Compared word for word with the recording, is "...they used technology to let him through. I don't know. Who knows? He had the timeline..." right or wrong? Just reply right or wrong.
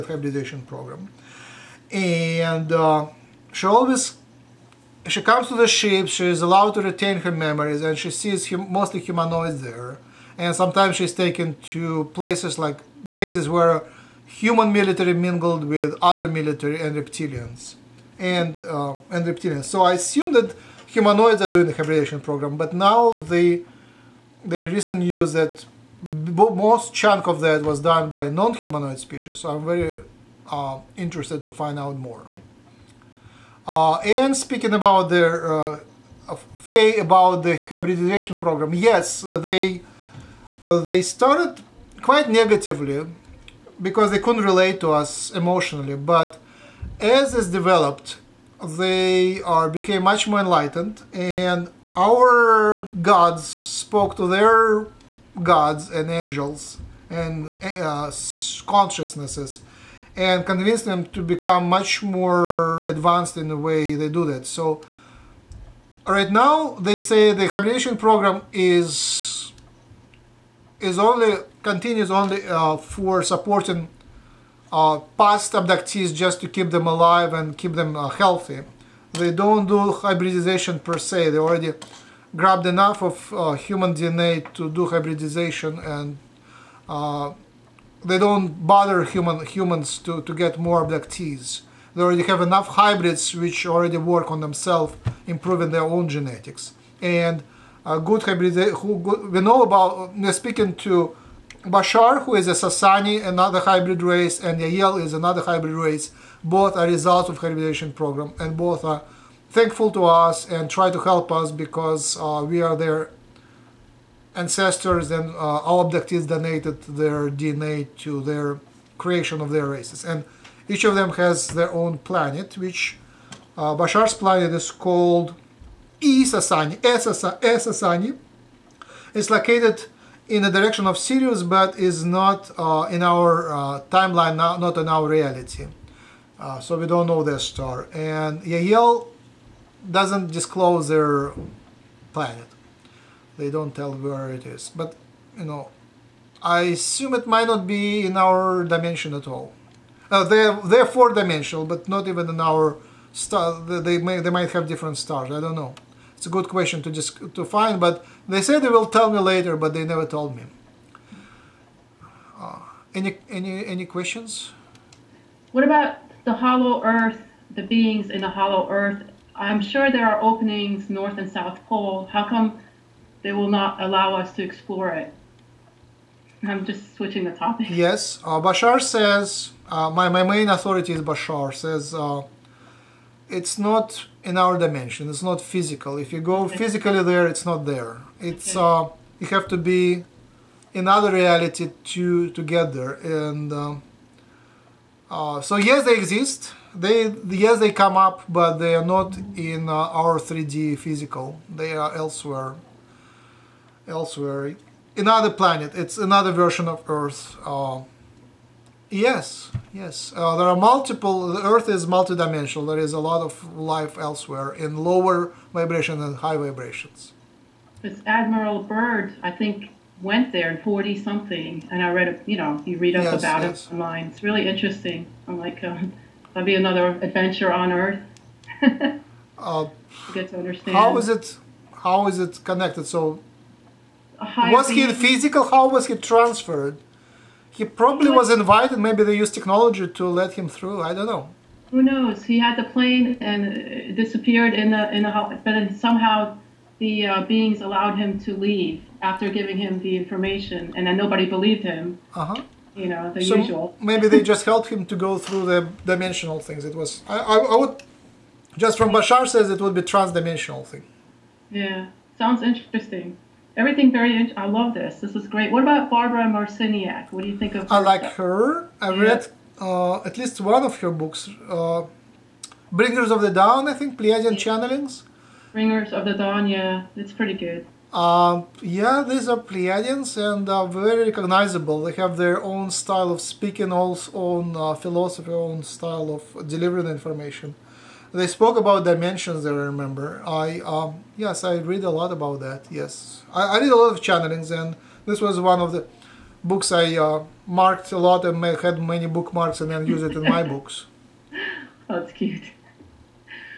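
wrong.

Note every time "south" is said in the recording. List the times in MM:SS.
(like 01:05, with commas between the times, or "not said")
02:51.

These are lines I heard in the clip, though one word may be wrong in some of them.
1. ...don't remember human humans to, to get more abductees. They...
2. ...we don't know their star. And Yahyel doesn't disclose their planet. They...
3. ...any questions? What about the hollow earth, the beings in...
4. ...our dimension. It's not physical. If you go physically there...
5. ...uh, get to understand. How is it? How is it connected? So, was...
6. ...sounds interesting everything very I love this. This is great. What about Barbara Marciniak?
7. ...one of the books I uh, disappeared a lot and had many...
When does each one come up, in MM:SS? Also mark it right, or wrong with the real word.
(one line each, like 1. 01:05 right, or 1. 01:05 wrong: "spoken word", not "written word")
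1. 01:28 wrong: "bother", not "remember"
2. 02:16 right
3. 02:43 right
4. 03:04 right
5. 03:49 right
6. 04:22 right
7. 04:55 wrong: "marked", not "disappeared".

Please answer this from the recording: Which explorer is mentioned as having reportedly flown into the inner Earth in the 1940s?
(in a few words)
Admiral Byrd.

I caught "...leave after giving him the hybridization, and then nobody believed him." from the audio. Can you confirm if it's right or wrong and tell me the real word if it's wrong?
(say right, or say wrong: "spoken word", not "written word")
wrong: "information", not "hybridization".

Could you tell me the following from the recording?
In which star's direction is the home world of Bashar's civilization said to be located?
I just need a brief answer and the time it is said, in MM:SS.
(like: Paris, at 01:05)
Sirius, at 02:10.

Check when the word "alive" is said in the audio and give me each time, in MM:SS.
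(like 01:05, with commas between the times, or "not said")
01:16.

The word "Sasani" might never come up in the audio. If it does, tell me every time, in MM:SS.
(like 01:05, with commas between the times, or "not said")
01:42, 02:06.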